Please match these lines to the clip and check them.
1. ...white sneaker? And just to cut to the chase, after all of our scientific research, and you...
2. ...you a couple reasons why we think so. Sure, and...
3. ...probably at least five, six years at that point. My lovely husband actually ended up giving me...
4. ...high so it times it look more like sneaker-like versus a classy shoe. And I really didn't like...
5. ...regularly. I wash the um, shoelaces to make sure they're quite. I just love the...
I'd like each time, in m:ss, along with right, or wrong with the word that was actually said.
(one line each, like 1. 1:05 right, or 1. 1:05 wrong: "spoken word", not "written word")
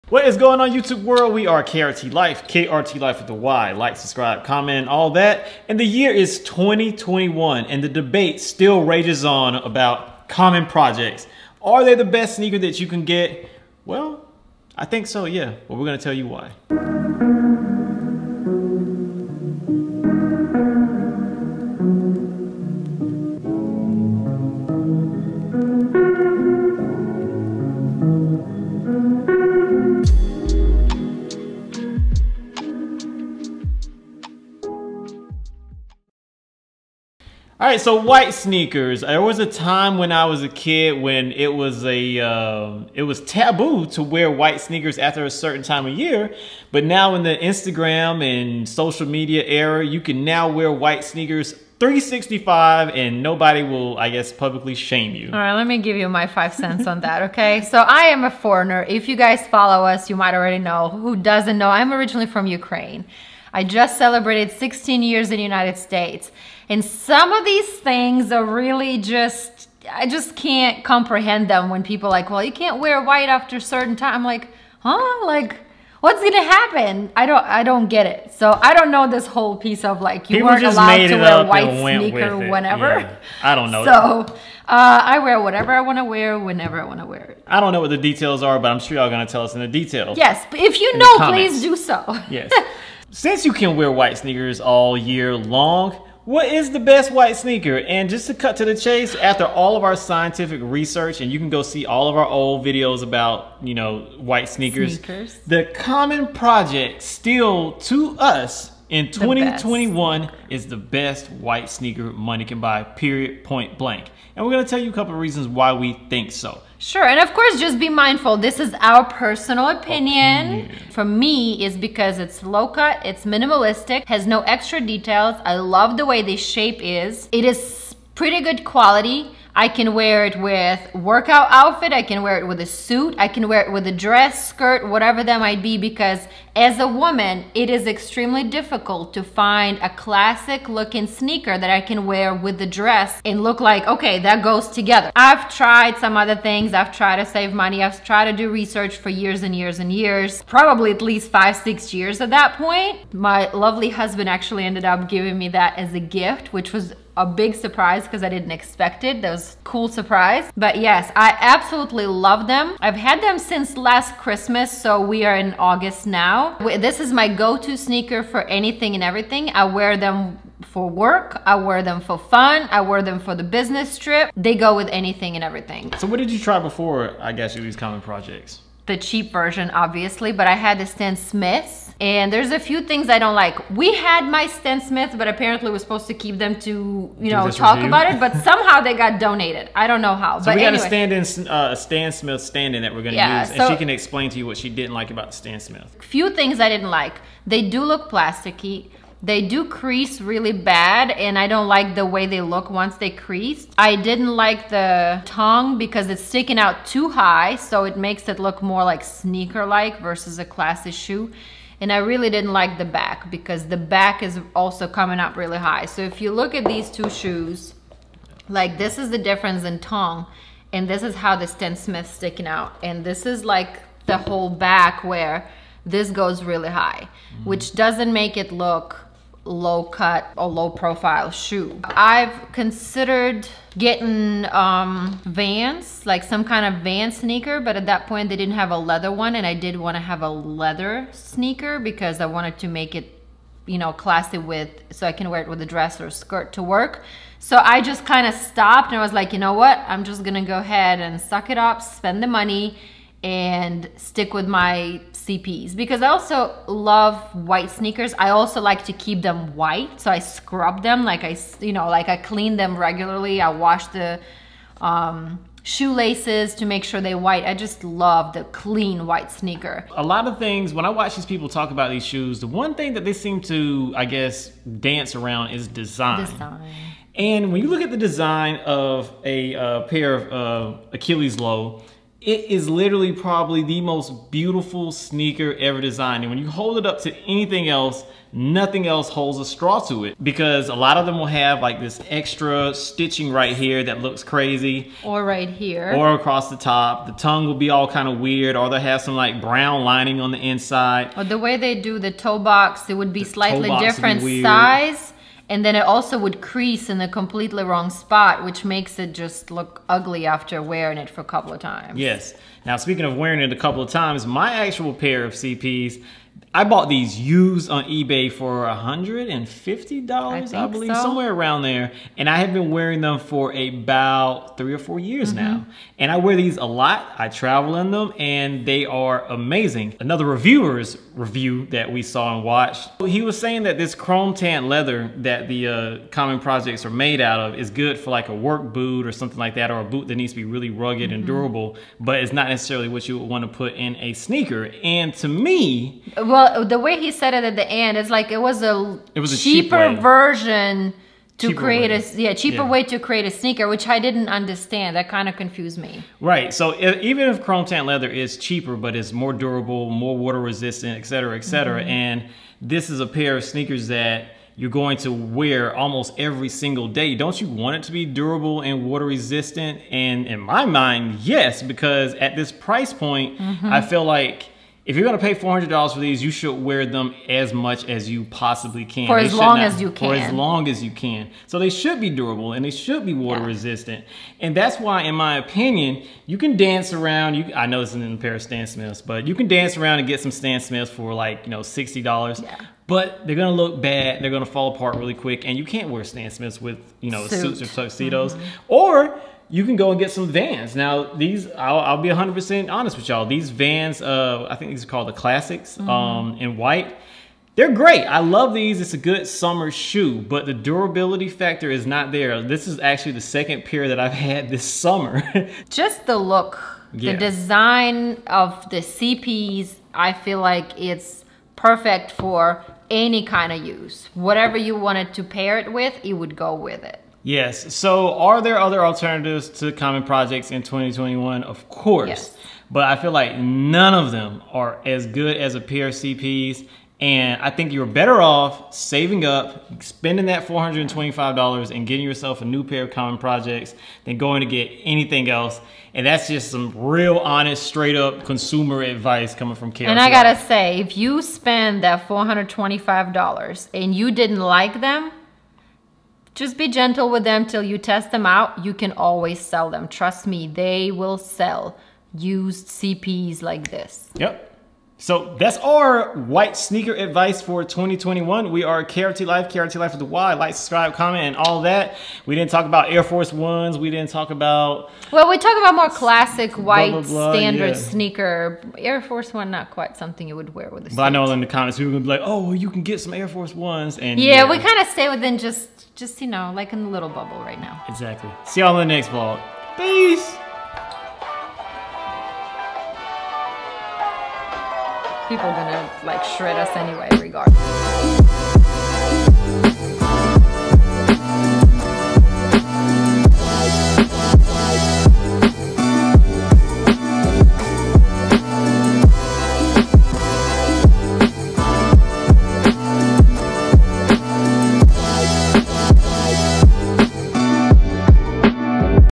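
1. 1:37 right
2. 1:54 right
3. 2:30 right
4. 3:27 wrong: "makes", not "times"
5. 4:22 wrong: "white", not "quite".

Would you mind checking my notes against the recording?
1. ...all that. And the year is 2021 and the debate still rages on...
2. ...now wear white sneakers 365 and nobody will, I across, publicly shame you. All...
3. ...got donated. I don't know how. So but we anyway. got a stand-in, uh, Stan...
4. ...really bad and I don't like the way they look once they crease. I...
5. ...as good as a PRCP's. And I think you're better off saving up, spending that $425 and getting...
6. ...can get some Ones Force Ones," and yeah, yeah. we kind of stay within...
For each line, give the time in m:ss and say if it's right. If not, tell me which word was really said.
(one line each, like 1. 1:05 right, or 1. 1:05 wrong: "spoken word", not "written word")
1. 0:04 right
2. 0:50 wrong: "guess", not "across"
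3. 3:08 right
4. 3:20 right
5. 7:14 right
6. 8:02 wrong: "Air", not "Ones".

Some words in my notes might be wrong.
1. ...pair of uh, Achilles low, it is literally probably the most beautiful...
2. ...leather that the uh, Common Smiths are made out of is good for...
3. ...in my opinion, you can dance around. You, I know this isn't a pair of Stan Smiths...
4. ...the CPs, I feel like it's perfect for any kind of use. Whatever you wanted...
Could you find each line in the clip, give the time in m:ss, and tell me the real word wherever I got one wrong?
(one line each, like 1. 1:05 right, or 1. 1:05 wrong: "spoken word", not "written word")
1. 4:39 right
2. 5:34 wrong: "Projects", not "Smiths"
3. 6:25 right
4. 6:58 right.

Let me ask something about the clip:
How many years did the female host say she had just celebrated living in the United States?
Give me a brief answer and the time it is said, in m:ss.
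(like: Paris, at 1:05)
16, at 1:04.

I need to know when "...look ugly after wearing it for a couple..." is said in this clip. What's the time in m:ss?
5:09.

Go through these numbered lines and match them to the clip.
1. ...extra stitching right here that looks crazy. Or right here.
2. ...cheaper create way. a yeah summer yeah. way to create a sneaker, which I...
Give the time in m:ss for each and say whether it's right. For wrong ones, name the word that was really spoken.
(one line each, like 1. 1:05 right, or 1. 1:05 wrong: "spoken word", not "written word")
1. 4:52 right
2. 5:51 wrong: "cheaper", not "summer".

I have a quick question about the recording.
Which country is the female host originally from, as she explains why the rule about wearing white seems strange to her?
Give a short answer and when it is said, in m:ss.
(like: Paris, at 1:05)
Ukraine, at 1:02.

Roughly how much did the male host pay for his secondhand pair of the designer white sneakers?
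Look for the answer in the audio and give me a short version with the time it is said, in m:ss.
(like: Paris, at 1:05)
$150, at 5:18.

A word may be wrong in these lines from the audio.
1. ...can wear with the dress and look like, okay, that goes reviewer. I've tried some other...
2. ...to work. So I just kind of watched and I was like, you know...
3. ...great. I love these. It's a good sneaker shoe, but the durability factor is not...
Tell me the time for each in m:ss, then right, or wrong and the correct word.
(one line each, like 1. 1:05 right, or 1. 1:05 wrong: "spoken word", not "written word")
1. 2:21 wrong: "together", not "reviewer"
2. 4:06 wrong: "stopped", not "watched"
3. 6:47 wrong: "summer", not "sneaker".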